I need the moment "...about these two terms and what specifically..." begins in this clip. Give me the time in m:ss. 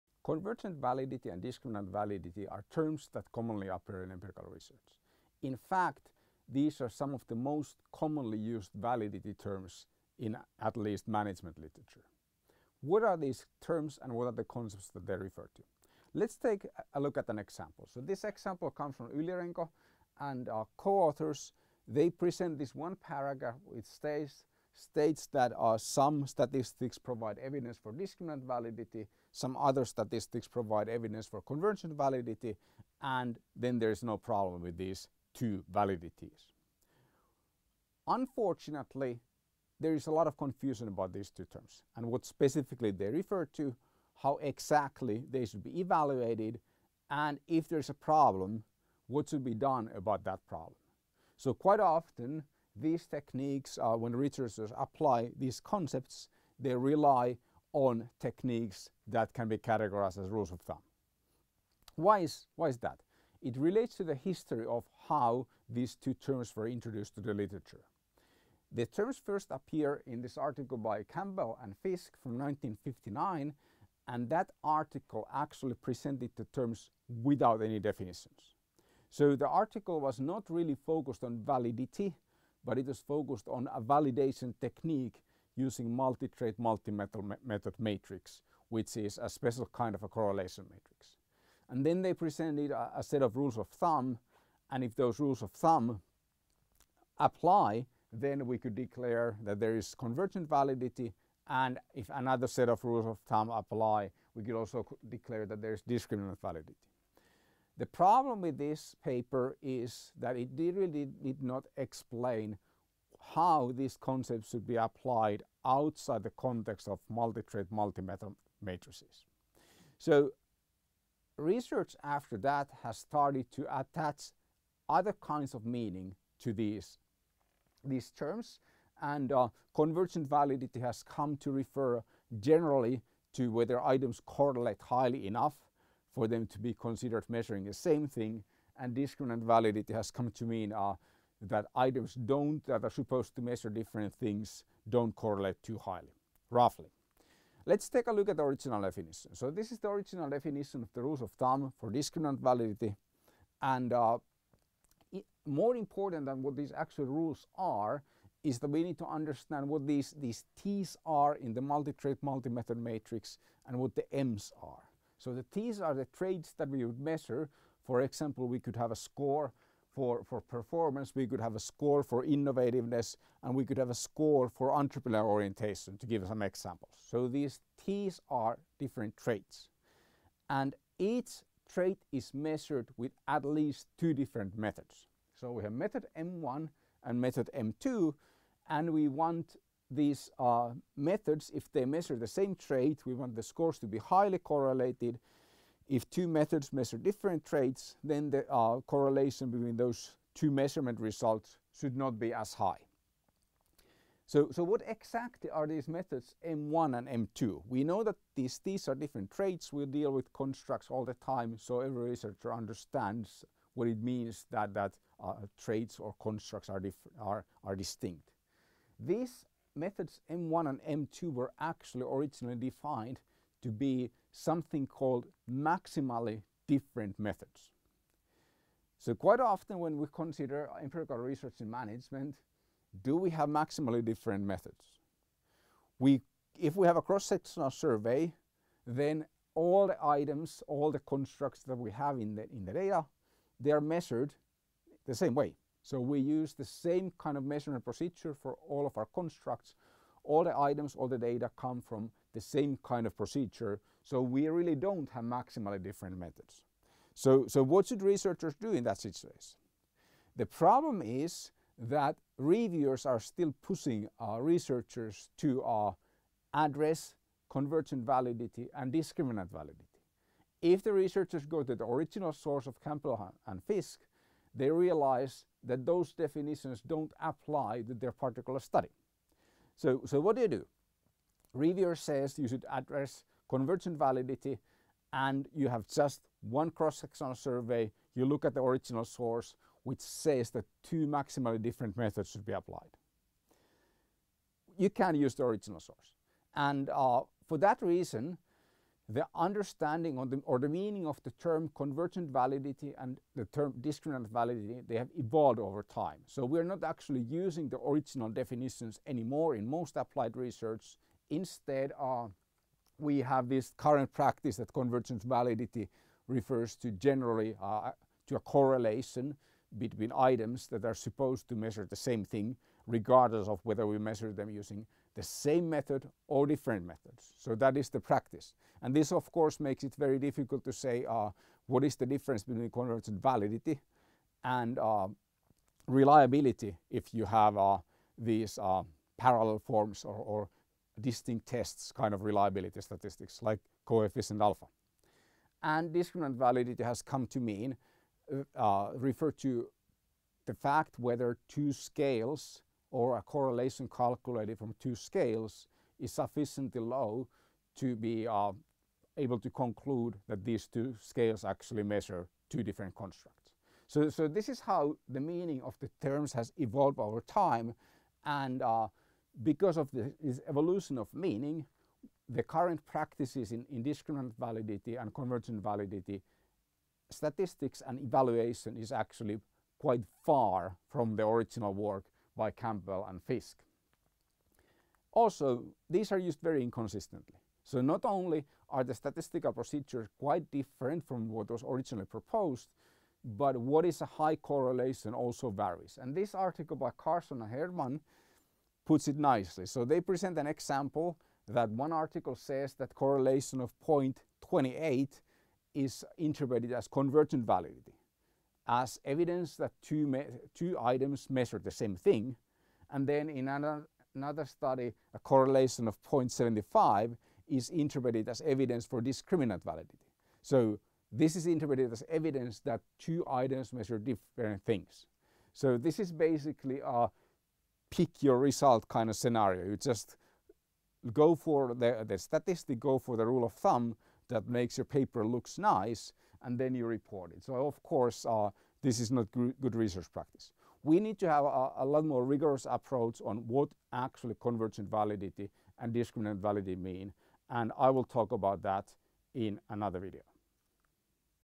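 0:40.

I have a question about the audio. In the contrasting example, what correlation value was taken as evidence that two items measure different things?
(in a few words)
0.75.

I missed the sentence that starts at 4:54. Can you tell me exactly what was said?
You can use the original source.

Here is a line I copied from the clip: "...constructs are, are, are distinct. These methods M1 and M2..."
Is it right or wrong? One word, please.
right.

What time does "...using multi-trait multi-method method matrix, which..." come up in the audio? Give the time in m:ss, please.
1:25.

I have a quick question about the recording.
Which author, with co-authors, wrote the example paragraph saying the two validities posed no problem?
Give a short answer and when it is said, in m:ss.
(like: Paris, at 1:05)
Yli-Renko, at 0:19.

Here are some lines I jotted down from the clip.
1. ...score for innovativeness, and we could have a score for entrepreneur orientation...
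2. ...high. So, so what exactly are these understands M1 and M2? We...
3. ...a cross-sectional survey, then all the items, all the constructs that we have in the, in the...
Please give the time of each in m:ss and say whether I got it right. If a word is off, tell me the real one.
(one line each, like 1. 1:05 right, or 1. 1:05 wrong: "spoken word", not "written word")
1. 2:51 right
2. 3:22 wrong: "methods", not "understands"
3. 3:56 right.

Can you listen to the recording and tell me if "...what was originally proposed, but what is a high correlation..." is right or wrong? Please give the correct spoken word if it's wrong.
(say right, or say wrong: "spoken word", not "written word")
right.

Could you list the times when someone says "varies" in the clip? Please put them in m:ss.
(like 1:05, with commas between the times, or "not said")
6:35.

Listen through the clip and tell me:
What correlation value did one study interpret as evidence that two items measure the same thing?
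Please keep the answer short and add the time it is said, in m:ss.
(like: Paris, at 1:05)
0.28, at 6:43.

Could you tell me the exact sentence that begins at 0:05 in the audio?
In fact, these are some of the most commonly used validity terms in at least management literature.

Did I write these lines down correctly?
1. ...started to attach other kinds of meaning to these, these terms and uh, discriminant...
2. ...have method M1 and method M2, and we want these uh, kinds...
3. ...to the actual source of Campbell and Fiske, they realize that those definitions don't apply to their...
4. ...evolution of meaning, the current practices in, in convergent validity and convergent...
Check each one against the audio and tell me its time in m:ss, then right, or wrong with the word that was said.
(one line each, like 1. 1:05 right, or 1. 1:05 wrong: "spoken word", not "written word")
1. 2:02 wrong: "convergent", not "discriminant"
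2. 3:05 wrong: "methods", not "kinds"
3. 4:31 wrong: "original", not "actual"
4. 6:10 wrong: "discriminant", not "convergent".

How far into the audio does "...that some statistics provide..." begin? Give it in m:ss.
0:25.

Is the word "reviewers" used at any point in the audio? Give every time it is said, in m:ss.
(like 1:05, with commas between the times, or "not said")
4:22, 4:41.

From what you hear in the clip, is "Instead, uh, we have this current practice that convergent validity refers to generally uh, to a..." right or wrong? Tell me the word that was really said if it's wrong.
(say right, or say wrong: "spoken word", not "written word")
right.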